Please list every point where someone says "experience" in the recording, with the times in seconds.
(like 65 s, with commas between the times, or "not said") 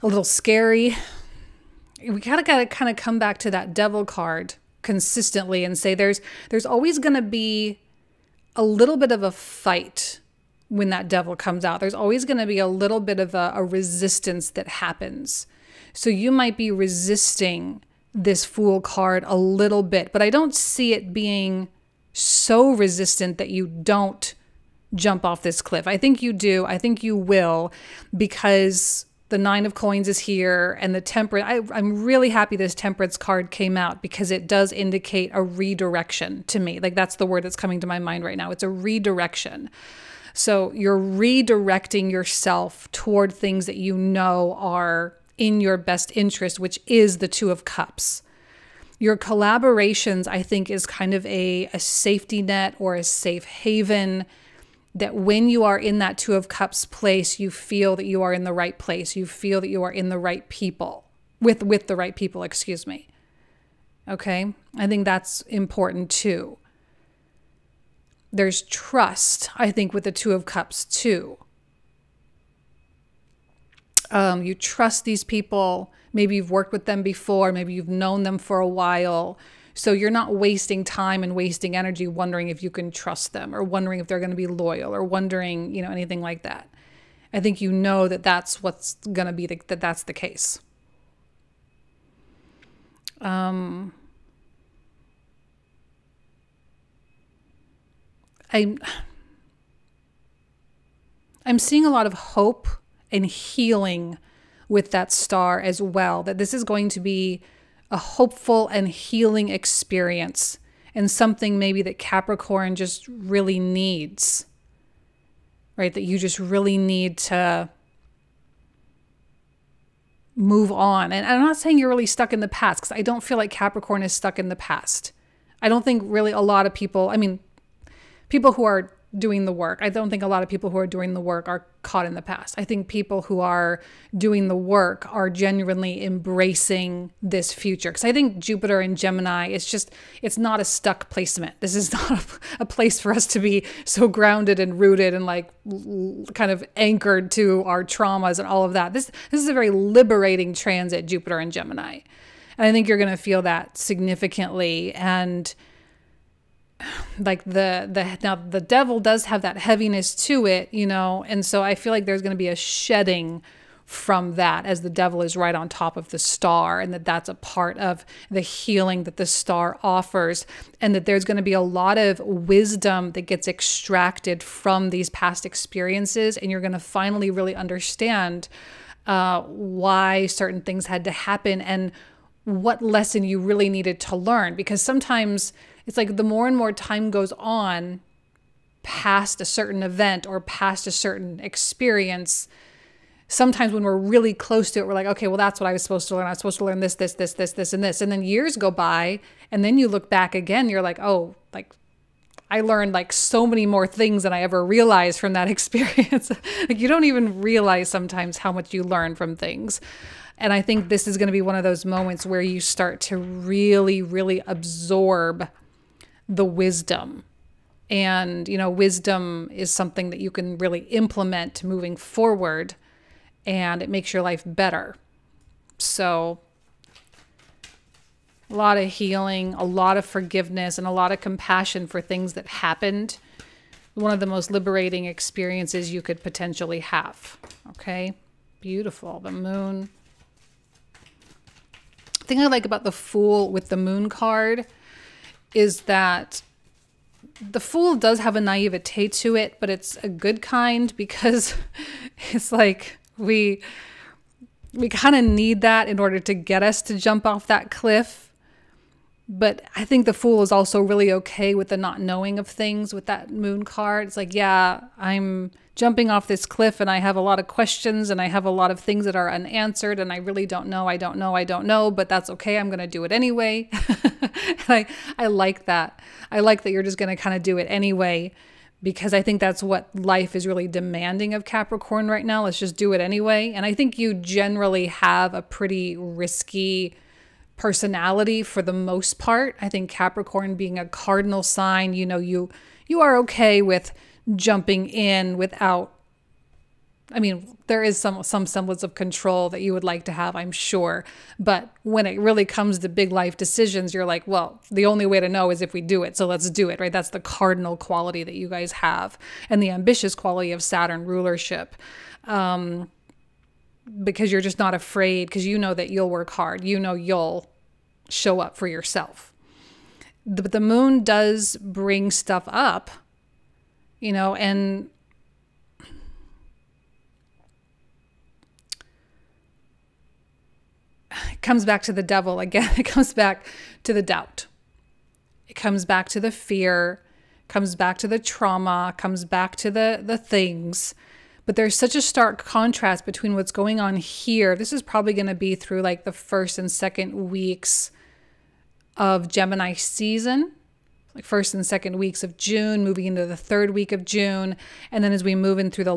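109 s, 175 s, 191 s, 205 s, 235 s.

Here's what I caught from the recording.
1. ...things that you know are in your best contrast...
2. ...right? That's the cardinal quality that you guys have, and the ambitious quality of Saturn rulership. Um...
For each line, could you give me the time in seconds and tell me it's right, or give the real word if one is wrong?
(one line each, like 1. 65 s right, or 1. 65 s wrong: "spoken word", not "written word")
1. 43 s wrong: "interest", not "contrast"
2. 306 s right.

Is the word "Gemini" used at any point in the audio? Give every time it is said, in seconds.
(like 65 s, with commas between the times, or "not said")
138 s, 151 s, 349 s.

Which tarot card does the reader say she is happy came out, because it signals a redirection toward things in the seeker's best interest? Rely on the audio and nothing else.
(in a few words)
Temperance.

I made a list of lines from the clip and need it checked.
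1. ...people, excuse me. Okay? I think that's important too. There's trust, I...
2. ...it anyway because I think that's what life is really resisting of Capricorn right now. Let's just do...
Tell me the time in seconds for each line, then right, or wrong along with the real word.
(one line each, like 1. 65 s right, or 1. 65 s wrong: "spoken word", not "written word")
1. 62 s right
2. 277 s wrong: "demanding", not "resisting".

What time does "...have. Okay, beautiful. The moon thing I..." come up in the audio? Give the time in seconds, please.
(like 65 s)
236 s.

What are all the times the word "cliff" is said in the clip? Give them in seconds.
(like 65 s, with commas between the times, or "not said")
25 s, 257 s, 266 s.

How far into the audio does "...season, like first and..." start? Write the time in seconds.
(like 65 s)
349 s.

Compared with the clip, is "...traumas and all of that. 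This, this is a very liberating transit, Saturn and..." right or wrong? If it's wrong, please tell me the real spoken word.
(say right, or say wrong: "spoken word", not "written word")
wrong: "Jupiter", not "Saturn".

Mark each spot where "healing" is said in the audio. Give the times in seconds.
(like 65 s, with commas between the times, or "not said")
103 s, 108 s, 168 s, 228 s.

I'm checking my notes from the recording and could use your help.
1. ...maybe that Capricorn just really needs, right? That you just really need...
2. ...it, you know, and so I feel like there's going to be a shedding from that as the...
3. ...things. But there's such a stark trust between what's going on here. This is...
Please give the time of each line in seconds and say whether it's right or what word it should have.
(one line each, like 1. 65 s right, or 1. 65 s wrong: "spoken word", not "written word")
1. 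111 s right
2. 160 s right
3. 340 s wrong: "contrast", not "trust".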